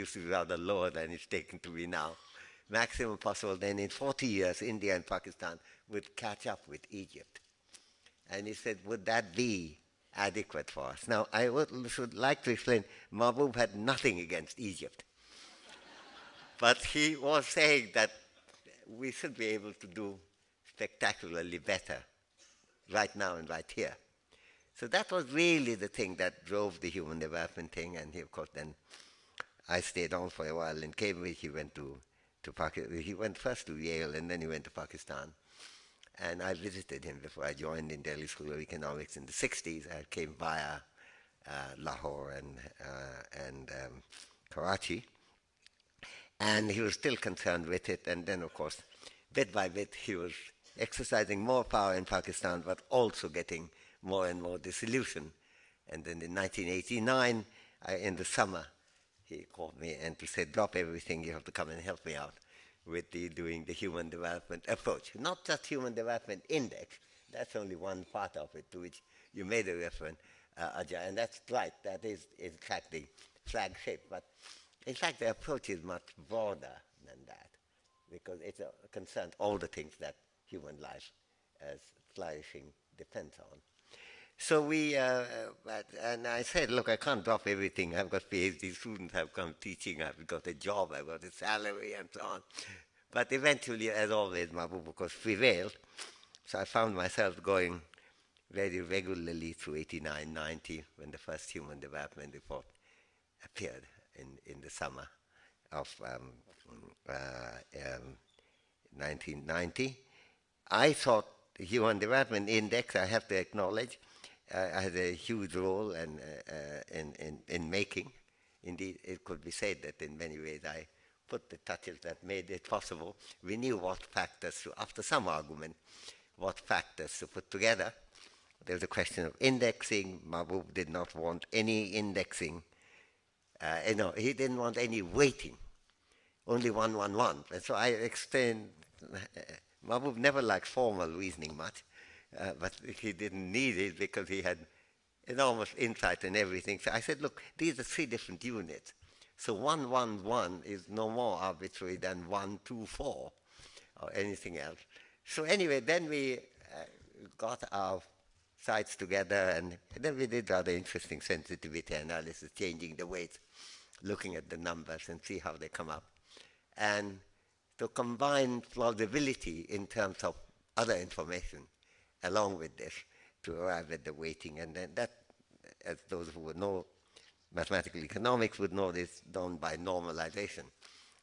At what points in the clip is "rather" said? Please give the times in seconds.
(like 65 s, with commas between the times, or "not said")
0 s, 160 s.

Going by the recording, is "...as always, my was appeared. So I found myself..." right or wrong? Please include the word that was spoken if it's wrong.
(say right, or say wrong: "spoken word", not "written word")
wrong: "prevailed", not "appeared".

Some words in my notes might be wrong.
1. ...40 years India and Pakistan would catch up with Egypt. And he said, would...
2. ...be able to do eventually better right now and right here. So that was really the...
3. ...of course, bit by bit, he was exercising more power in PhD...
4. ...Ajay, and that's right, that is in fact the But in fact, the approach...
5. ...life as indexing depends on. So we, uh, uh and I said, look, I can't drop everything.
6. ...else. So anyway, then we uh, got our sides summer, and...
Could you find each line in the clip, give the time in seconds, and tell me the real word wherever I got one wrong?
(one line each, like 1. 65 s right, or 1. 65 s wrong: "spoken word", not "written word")
1. 3 s right
2. 19 s wrong: "spectacularly", not "eventually"
3. 48 s wrong: "Pakistan", not "PhD"
4. 70 s right
5. 80 s wrong: "flourishing", not "indexing"
6. 154 s wrong: "together", not "summer".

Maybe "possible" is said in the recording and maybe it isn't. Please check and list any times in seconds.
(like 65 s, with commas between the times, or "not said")
3 s, 122 s.